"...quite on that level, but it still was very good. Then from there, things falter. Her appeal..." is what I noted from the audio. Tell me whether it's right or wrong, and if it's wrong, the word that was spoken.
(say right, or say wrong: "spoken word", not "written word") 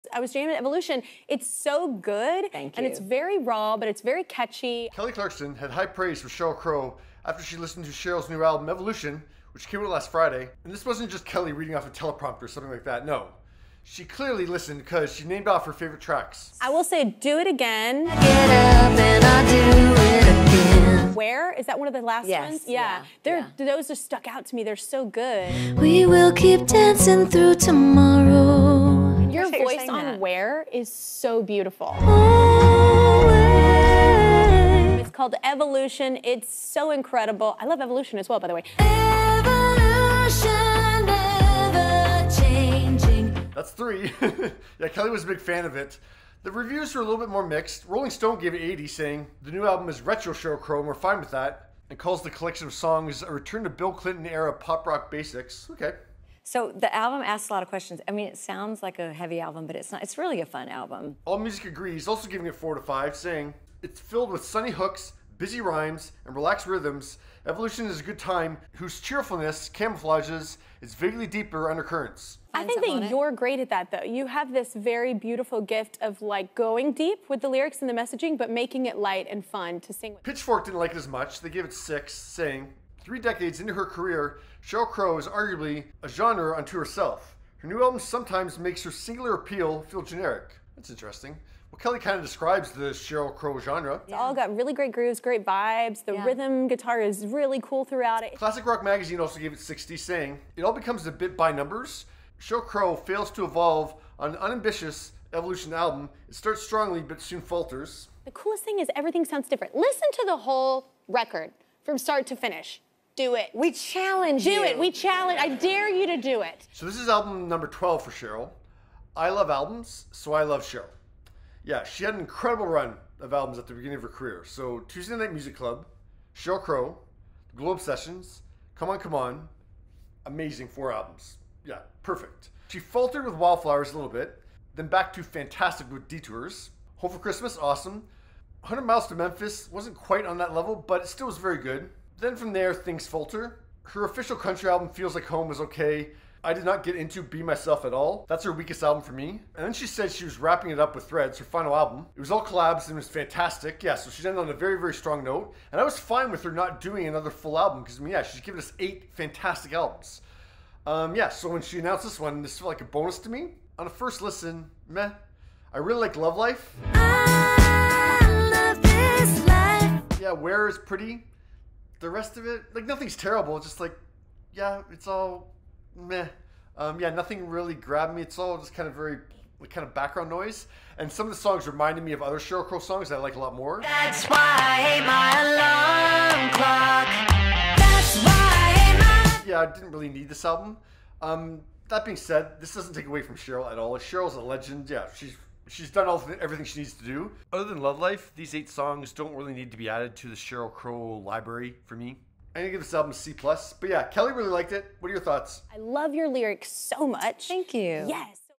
wrong: "official", not "appeal".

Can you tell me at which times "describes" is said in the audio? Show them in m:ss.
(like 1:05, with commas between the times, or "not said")
1:32.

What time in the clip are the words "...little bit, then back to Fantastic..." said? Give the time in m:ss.
2:13.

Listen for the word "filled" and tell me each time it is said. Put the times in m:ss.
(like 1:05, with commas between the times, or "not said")
1:04.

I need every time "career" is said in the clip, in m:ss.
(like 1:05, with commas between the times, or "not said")
1:23, 2:04.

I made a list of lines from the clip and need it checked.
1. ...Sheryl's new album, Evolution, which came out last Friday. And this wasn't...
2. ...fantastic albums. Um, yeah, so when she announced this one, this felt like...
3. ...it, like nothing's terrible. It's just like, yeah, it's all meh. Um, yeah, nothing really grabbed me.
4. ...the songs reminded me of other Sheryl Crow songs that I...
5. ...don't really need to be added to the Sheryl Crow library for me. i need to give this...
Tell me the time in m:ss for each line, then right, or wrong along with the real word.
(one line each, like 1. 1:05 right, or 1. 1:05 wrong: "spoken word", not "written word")
1. 0:07 right
2. 2:39 right
3. 2:52 right
4. 3:01 right
5. 3:19 right.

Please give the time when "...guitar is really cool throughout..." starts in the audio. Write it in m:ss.
1:36.